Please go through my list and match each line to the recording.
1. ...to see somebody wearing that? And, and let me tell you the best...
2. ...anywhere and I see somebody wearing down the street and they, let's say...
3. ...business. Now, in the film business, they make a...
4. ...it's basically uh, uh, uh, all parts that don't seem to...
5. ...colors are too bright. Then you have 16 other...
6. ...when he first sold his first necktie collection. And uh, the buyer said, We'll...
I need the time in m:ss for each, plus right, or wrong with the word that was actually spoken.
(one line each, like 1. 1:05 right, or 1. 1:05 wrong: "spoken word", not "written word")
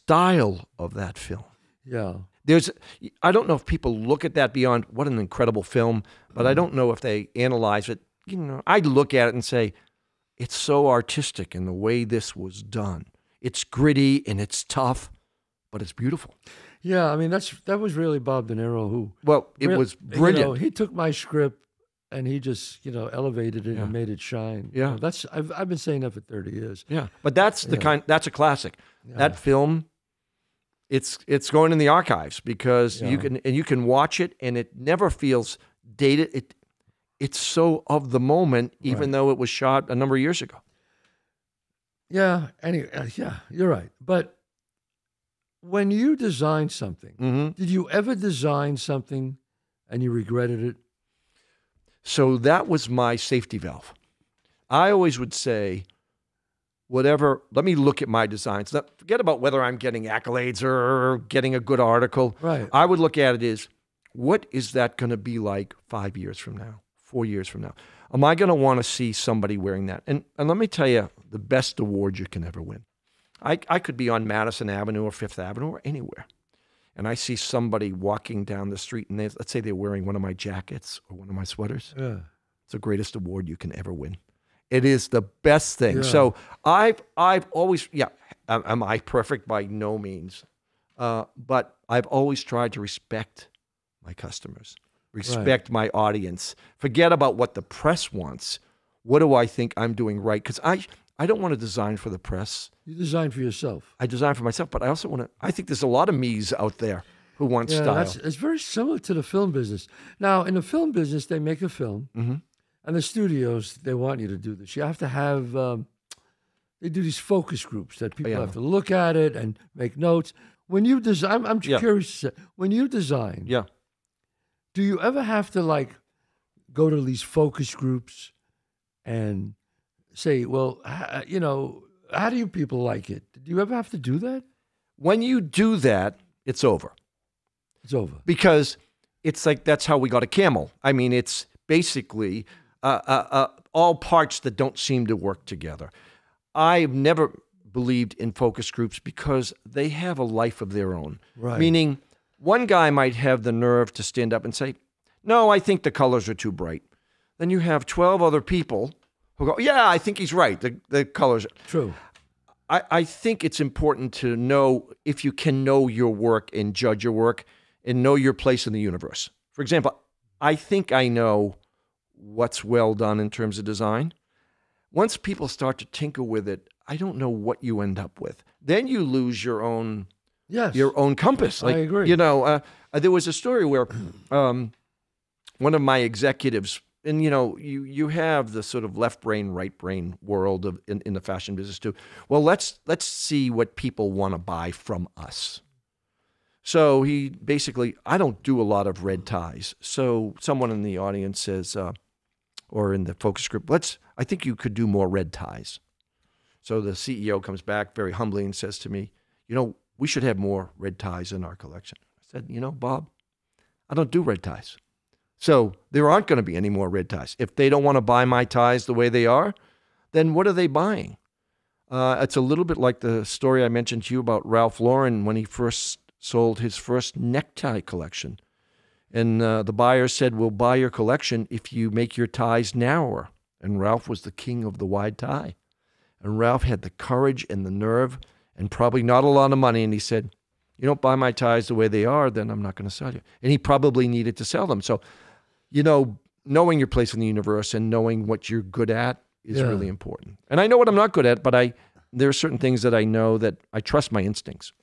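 1. 1:08 right
2. 1:15 wrong: "walking", not "wearing"
3. 1:49 right
4. 2:21 right
5. 2:35 wrong: "12", not "16"
6. 3:45 right.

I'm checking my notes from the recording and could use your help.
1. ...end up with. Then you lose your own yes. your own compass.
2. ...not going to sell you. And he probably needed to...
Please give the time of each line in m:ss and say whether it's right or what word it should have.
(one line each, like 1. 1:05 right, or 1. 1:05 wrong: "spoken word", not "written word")
1. 2:57 right
2. 4:02 right.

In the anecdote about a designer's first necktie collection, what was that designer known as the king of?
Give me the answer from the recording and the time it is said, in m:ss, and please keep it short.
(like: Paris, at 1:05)
The wide tie, at 3:54.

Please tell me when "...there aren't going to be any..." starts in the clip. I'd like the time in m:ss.
3:35.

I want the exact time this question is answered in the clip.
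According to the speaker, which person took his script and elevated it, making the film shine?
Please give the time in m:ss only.
0:18.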